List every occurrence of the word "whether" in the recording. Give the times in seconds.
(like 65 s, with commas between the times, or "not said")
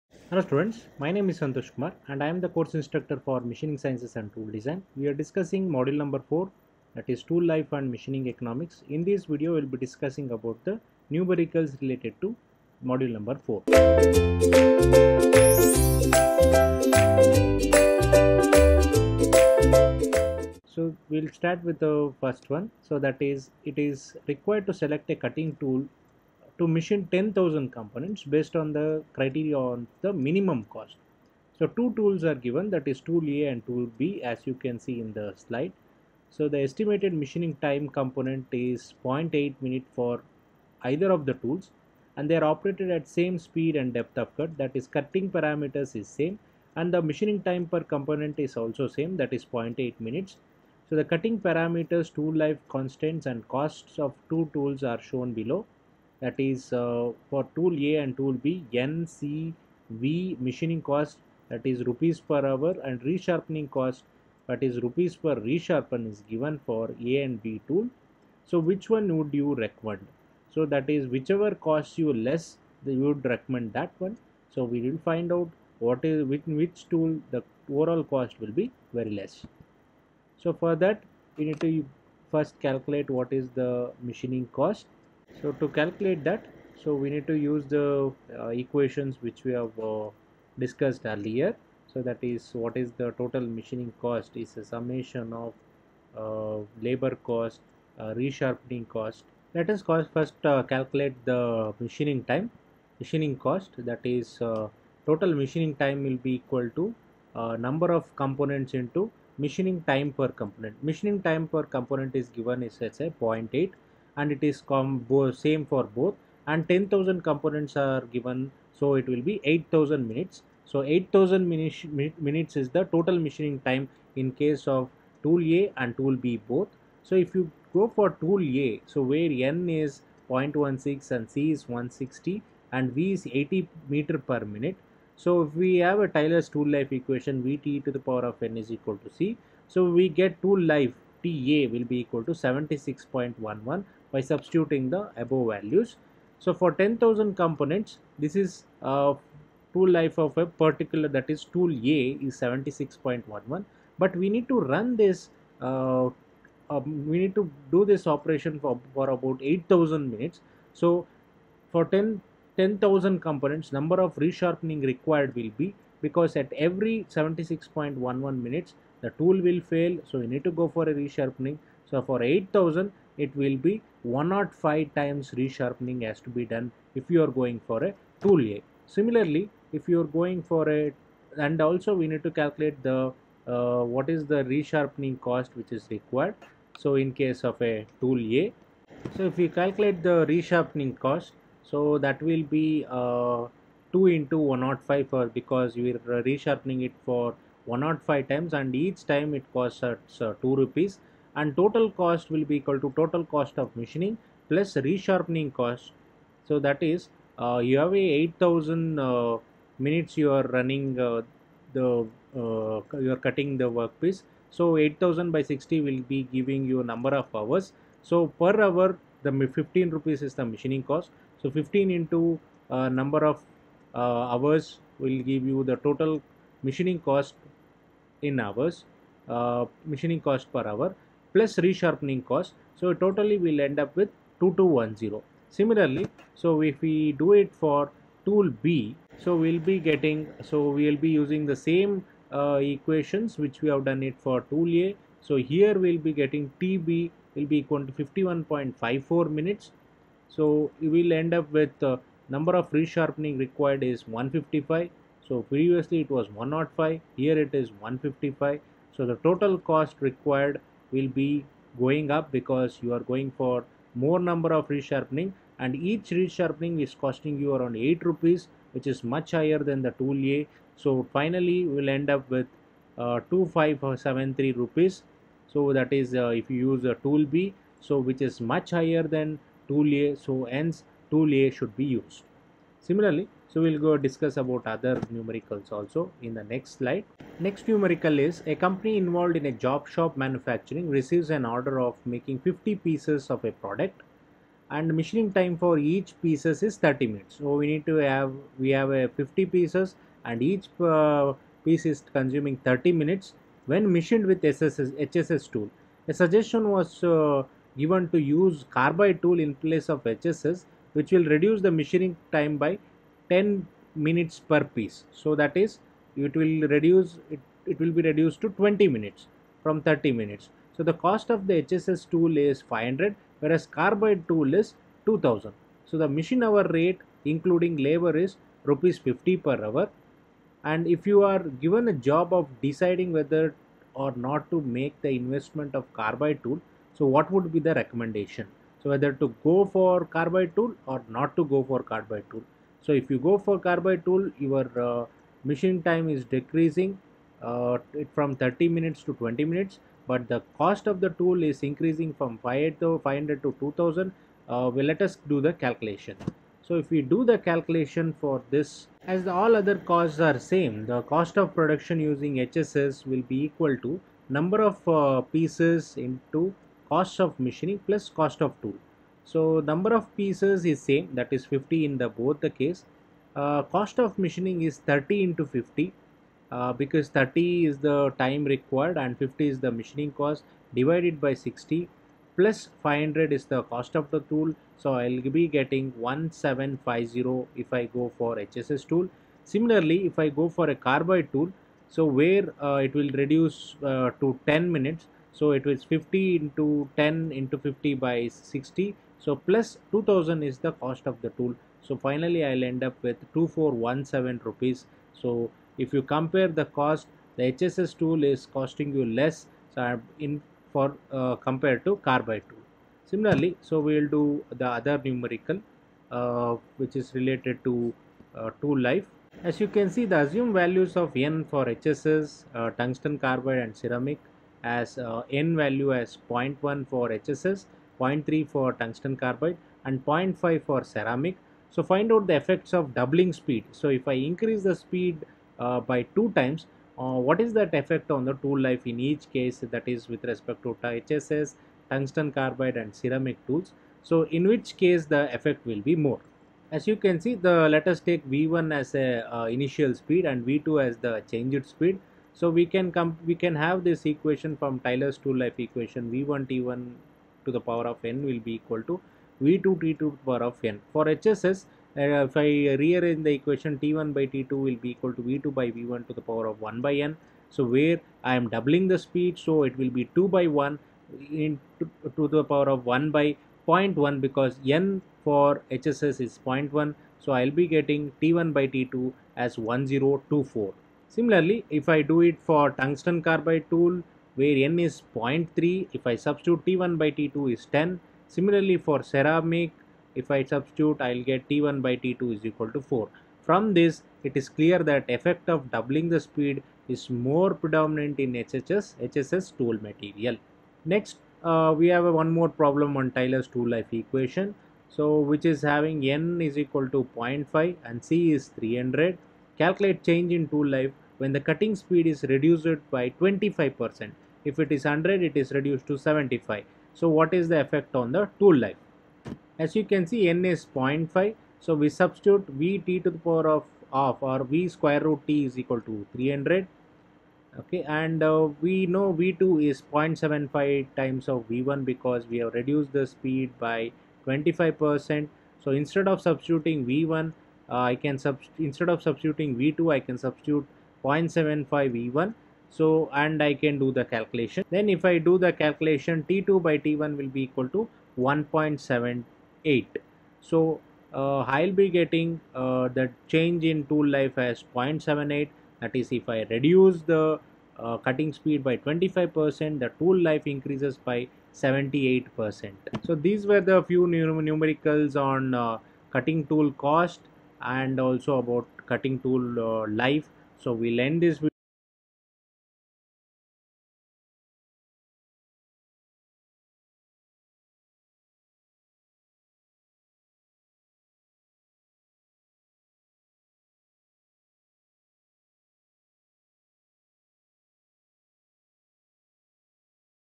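333 s, 338 s.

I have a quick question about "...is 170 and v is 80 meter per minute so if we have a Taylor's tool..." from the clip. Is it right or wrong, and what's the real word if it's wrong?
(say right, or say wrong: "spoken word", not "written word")
wrong: "160", not "170".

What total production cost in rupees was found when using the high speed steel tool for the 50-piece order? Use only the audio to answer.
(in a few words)
1750.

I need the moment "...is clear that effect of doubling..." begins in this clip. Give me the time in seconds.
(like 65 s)
494 s.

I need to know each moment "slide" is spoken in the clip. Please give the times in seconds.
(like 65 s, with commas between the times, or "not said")
35 s, 286 s.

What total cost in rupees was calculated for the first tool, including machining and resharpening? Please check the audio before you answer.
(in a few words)
2210.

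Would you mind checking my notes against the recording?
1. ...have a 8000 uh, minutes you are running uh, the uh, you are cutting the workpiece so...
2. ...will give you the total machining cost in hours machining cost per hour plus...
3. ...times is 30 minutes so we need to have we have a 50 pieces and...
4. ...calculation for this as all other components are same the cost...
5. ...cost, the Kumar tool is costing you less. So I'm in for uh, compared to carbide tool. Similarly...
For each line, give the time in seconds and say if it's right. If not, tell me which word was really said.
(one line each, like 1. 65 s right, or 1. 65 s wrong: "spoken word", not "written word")
1. 207 s right
2. 224 s right
3. 296 s wrong: "pieces", not "times"
4. 357 s wrong: "costs", not "components"
5. 406 s wrong: "HSS", not "Kumar".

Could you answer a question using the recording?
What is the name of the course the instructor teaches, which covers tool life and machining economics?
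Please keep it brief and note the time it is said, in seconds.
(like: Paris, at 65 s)
Machining Sciences and Tool Design, at 3 s.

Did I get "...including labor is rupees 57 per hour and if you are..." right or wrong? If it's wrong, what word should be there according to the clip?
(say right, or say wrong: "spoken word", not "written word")
wrong: "50", not "57".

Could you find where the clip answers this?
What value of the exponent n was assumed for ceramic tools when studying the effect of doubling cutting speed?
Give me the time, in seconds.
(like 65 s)
430 s.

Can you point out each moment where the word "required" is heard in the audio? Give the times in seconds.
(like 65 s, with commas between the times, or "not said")
24 s, 164 s, 185 s, 253 s, 260 s, 378 s.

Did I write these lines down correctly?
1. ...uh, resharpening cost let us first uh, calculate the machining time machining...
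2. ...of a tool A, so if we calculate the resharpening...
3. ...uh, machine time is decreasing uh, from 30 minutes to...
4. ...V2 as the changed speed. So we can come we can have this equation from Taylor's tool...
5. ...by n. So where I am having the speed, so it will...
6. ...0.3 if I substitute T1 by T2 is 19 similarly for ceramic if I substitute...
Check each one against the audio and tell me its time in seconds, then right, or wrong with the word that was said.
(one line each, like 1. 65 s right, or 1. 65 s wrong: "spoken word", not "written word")
1. 97 s right
2. 187 s right
3. 344 s right
4. 450 s right
5. 466 s wrong: "doubling", not "having"
6. 485 s wrong: "10", not "19".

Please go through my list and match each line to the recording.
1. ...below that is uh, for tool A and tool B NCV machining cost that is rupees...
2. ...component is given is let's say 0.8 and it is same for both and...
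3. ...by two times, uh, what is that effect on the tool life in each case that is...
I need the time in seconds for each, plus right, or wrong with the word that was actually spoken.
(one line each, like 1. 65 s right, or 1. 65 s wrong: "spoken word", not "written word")
1. 55 s right
2. 111 s right
3. 435 s right.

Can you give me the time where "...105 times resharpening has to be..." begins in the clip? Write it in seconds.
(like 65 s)
174 s.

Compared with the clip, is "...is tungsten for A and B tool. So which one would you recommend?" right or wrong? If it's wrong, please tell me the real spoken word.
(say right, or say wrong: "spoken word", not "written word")
wrong: "given", not "tungsten".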